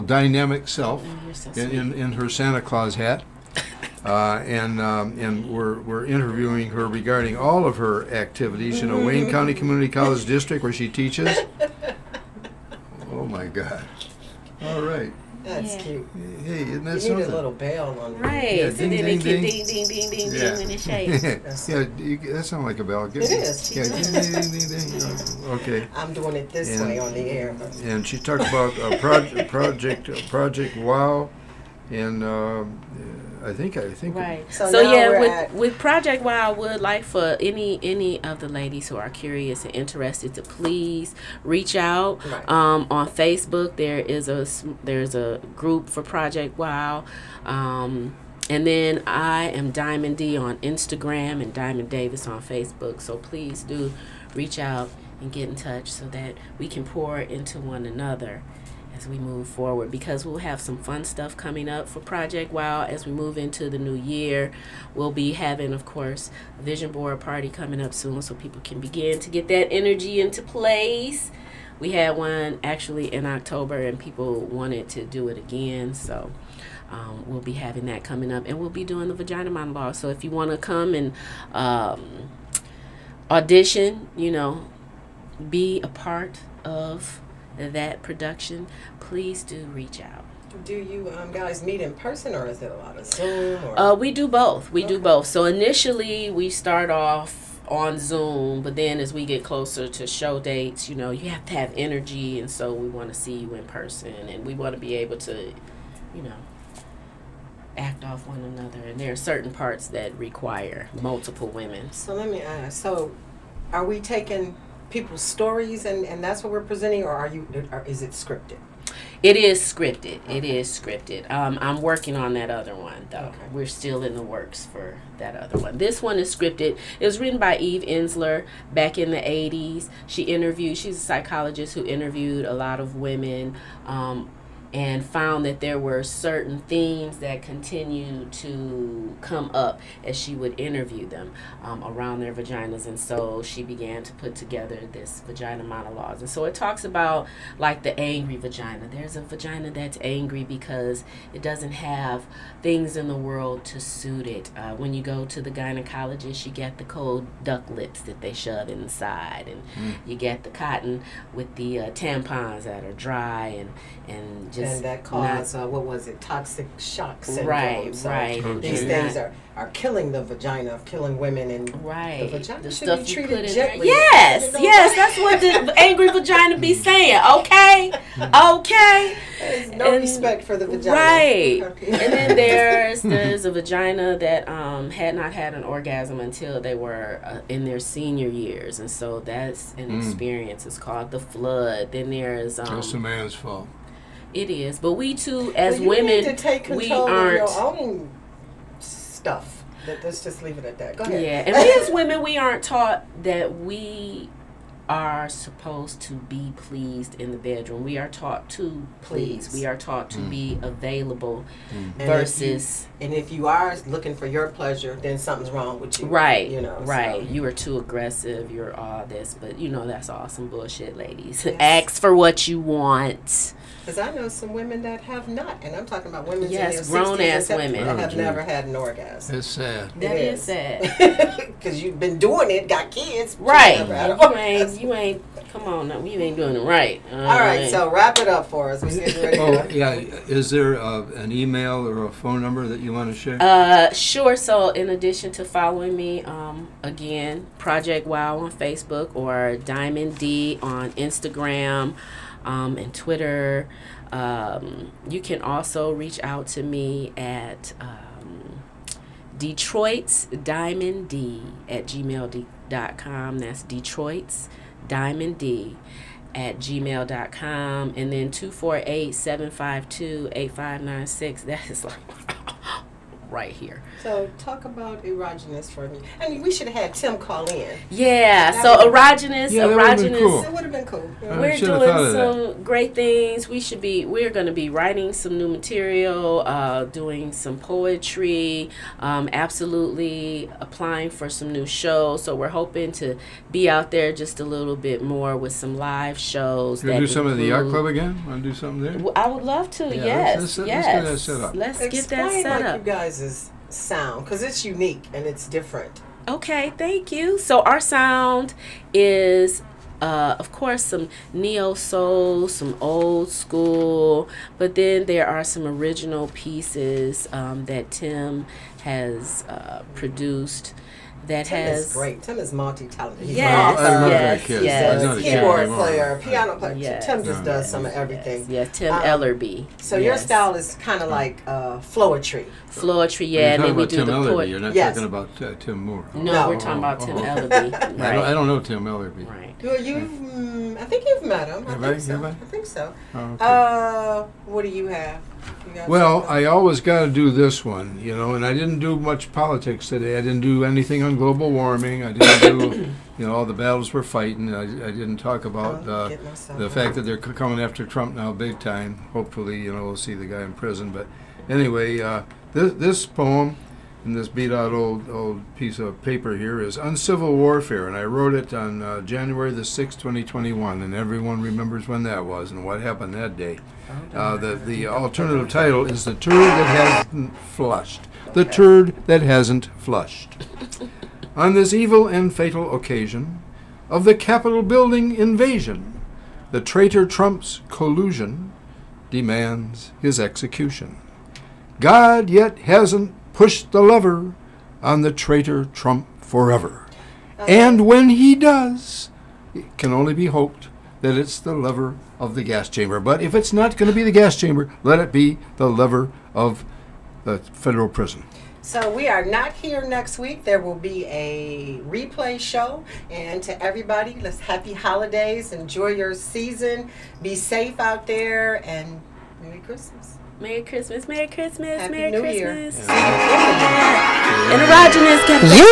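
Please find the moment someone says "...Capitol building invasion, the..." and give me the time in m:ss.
6:24.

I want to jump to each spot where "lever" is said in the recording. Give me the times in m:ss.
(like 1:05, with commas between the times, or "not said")
6:33, 6:41, 6:45.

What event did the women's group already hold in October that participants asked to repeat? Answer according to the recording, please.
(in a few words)
vision board party.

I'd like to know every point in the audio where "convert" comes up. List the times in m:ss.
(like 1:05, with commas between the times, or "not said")
not said.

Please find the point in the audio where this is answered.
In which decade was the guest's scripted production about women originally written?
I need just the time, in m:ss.
2:09.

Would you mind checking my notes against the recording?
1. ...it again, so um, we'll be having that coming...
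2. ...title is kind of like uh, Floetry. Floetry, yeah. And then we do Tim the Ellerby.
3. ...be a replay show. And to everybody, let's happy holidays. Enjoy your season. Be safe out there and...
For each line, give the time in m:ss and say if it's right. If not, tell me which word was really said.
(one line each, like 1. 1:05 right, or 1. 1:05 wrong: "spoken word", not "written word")
1. 1:15 right
2. 5:30 wrong: "style", not "title"
3. 6:50 right.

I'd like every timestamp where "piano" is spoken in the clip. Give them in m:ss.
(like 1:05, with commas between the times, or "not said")
5:26.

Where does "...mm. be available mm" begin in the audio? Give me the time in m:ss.
3:30.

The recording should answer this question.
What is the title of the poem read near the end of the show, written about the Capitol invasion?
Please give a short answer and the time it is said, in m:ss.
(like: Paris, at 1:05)
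Uncivil Warfare, at 6:06.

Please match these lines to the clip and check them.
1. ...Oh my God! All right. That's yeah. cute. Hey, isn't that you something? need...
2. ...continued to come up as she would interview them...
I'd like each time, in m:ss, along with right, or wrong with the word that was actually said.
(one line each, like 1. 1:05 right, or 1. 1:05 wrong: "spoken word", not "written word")
1. 0:13 right
2. 2:17 right.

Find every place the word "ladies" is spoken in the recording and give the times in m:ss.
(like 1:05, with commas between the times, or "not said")
0:38, 3:40.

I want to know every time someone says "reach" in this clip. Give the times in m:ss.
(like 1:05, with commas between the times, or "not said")
0:41, 0:54, 1:29, 4:15.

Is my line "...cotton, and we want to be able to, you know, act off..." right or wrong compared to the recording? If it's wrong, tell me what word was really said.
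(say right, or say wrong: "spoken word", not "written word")
wrong: "person", not "cotton".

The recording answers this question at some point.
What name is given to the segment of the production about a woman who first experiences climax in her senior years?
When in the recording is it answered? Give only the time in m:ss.
3:11.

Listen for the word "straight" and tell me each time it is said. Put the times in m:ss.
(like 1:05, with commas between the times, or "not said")
not said.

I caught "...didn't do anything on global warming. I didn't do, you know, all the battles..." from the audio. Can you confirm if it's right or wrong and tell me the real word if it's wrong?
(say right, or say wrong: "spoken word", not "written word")
right.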